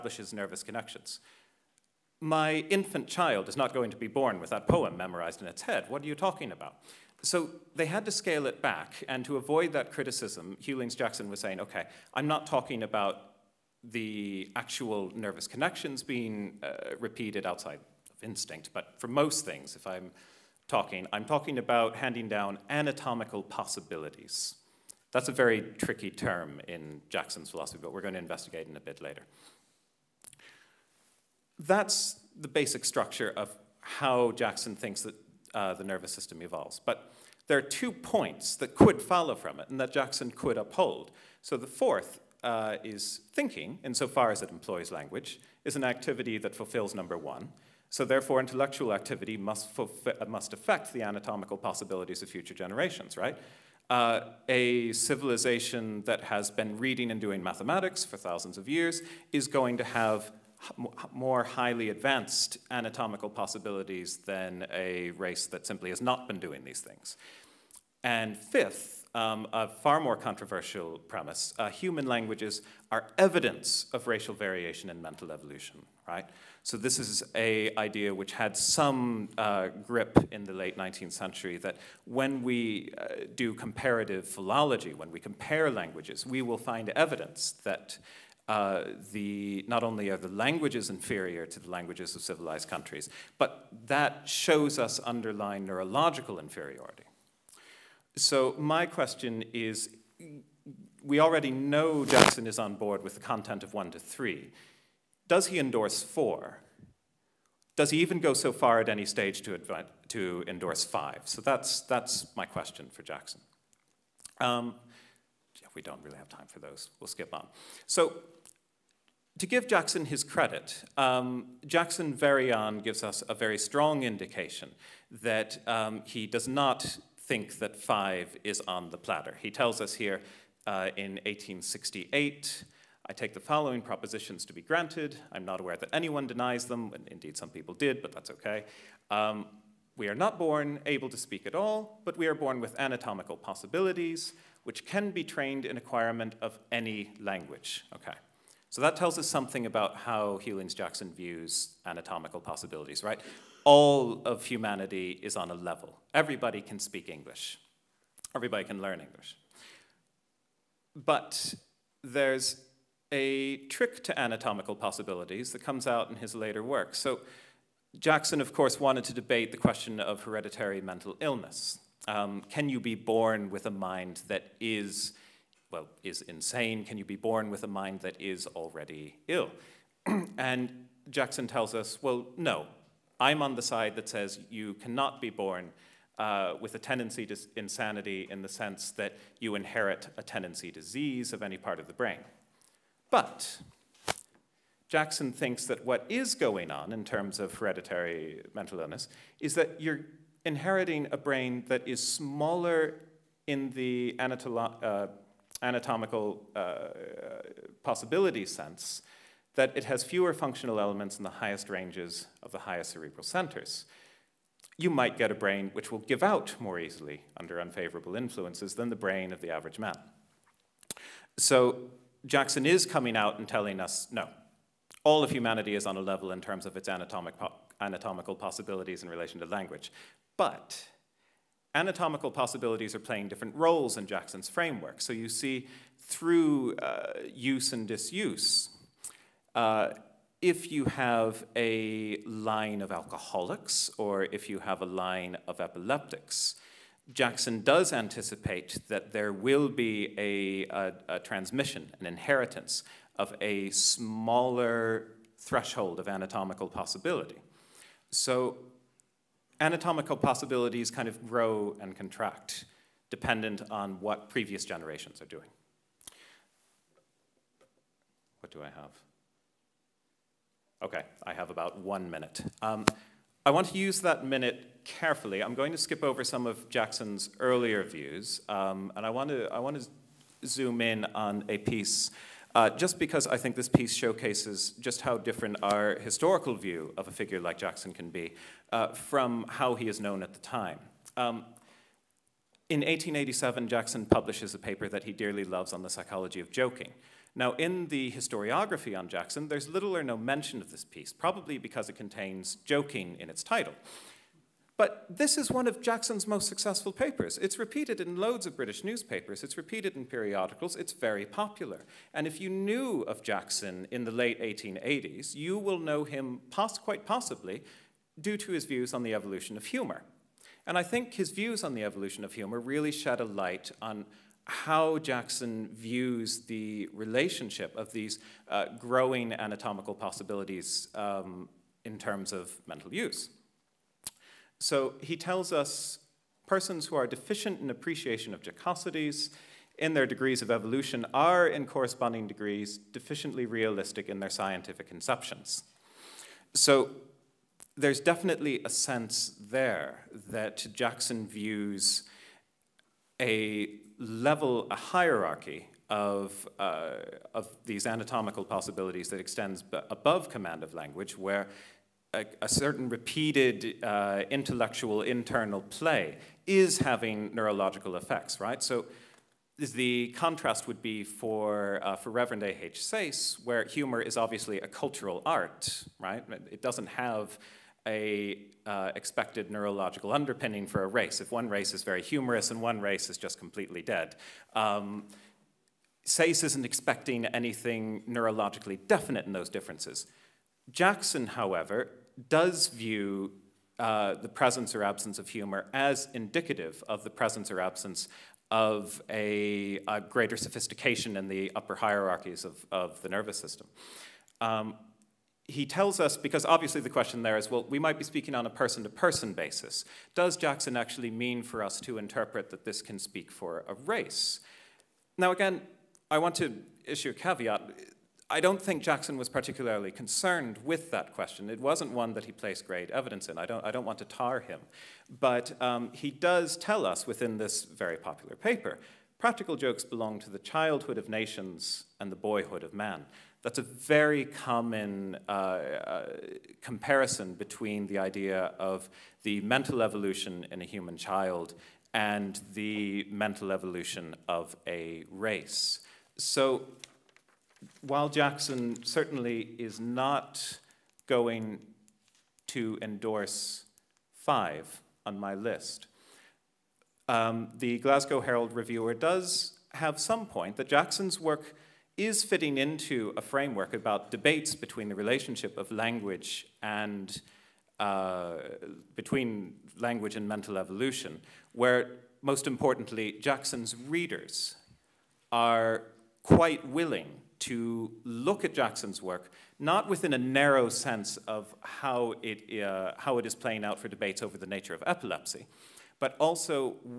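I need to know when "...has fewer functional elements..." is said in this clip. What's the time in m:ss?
3:29.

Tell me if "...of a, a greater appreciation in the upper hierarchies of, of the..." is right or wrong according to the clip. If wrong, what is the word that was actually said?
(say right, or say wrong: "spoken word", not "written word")
wrong: "sophistication", not "appreciation".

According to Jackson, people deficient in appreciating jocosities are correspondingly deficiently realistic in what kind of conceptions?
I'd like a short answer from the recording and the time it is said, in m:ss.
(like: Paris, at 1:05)
scientific conceptions, at 5:44.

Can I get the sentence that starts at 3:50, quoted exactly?
But anatomical possibilities are playing different roles in Jackson's framework.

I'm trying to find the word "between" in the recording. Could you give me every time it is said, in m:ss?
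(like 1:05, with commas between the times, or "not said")
7:17, 7:44, 7:48.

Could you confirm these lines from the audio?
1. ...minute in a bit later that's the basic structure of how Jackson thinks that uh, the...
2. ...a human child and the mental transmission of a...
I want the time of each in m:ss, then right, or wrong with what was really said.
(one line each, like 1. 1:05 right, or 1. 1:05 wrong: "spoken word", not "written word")
1. 0:28 wrong: "investigate", not "minute"
2. 7:20 wrong: "evolution", not "transmission".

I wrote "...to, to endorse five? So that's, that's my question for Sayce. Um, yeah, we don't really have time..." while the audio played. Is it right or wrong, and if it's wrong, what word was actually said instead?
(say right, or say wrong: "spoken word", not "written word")
wrong: "Jackson", not "Sayce".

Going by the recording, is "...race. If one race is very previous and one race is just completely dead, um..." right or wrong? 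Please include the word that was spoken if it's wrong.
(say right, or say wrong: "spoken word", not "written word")
wrong: "humorous", not "previous".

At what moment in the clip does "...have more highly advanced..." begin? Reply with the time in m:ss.
0:59.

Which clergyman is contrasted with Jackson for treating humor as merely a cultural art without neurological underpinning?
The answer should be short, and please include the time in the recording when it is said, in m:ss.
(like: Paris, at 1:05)
Reverend A.H. Sayce, at 6:12.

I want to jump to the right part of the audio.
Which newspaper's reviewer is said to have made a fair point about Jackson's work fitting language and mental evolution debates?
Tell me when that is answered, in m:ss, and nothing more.
7:37.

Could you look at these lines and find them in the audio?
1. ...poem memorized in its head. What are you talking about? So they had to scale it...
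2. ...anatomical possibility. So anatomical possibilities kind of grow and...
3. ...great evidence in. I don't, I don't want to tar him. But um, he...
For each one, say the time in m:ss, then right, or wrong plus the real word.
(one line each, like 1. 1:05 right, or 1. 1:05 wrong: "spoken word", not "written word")
1. 0:04 right
2. 4:16 right
3. 7:02 right.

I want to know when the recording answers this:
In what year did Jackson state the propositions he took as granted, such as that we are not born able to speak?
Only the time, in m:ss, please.
2:11.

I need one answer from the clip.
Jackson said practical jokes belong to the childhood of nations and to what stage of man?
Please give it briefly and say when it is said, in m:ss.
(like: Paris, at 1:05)
boyhood, at 7:12.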